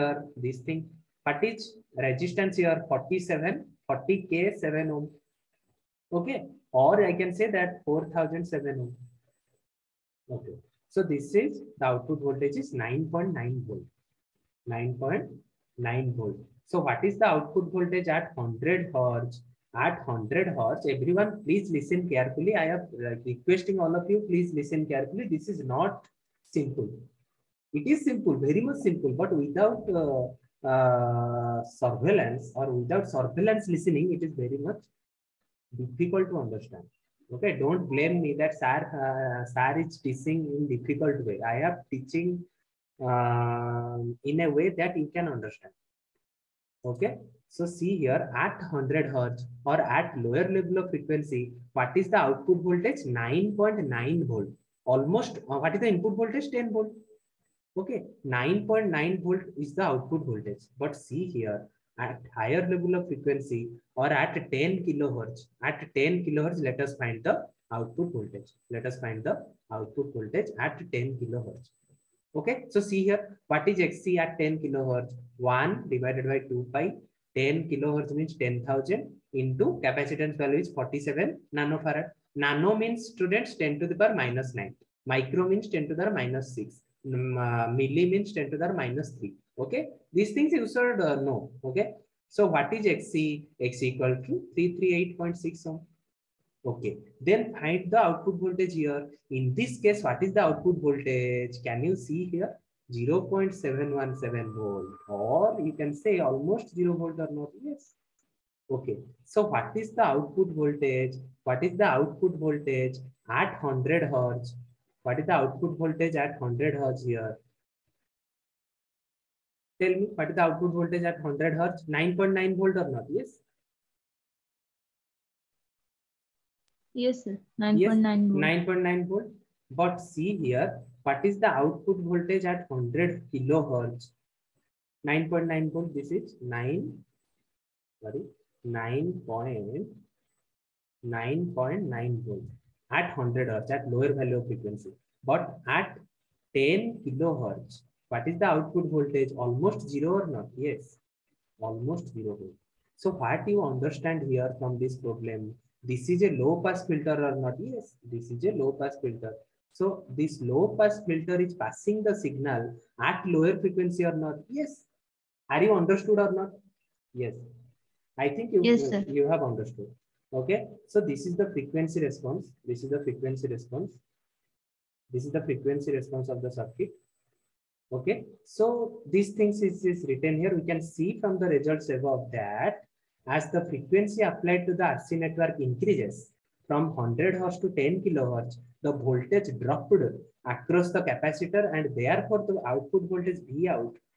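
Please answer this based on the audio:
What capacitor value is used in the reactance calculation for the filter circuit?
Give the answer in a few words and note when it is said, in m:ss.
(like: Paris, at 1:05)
47 nanofarad, at 1:20.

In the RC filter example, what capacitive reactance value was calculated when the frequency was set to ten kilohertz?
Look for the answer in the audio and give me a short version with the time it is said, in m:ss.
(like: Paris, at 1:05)
338.6 ohm, at 1:34.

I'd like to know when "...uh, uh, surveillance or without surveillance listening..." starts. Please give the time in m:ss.
0:30.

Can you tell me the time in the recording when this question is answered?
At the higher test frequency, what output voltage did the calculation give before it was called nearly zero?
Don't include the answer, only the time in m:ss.
1:42.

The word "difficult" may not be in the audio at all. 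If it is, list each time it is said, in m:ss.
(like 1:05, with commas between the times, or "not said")
0:35, 0:40.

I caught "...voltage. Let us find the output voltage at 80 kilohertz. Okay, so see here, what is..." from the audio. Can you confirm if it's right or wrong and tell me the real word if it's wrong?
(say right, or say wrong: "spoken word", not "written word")
wrong: "10", not "80".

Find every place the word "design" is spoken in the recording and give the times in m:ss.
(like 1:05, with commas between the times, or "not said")
not said.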